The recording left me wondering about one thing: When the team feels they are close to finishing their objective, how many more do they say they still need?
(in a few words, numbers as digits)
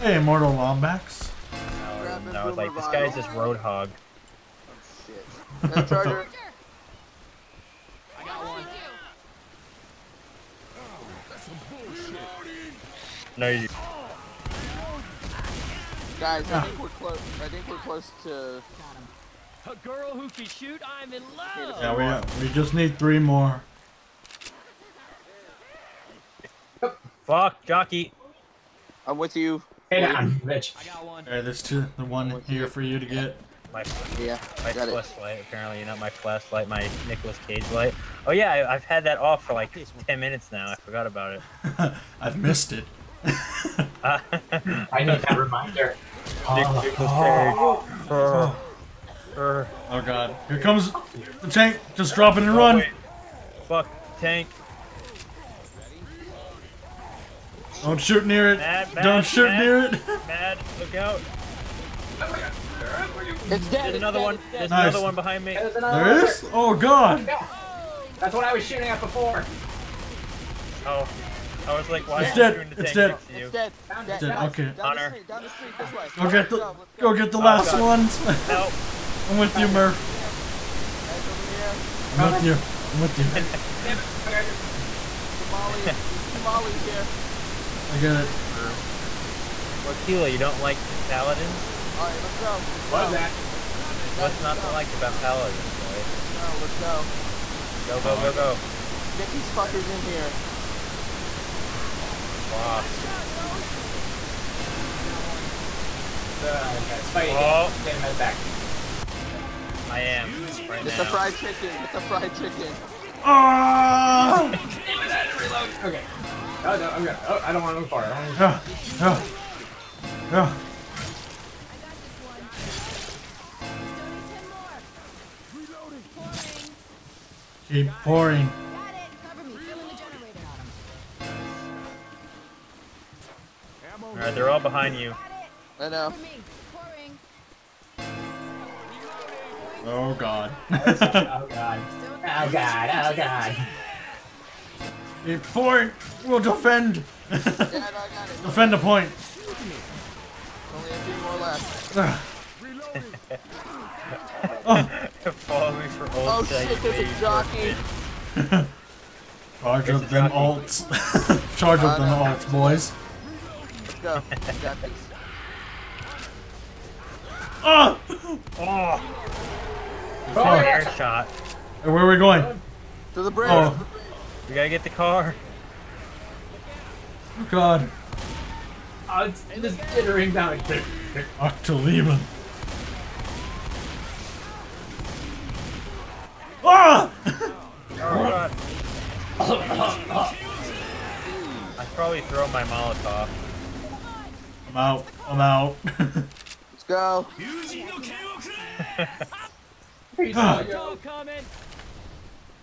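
3.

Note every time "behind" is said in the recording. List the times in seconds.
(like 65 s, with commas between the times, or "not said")
65 s, 134 s.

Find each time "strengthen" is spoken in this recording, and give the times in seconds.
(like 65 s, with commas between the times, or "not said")
not said.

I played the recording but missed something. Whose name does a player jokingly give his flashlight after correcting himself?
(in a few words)
Nicolas Cage.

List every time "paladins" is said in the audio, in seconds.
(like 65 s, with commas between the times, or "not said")
91 s, 95 s.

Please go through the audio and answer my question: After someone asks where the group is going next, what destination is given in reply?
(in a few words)
The bridge.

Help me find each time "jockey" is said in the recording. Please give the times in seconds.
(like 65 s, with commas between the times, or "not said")
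27 s, 157 s.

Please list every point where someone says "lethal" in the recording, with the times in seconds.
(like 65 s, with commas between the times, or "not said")
not said.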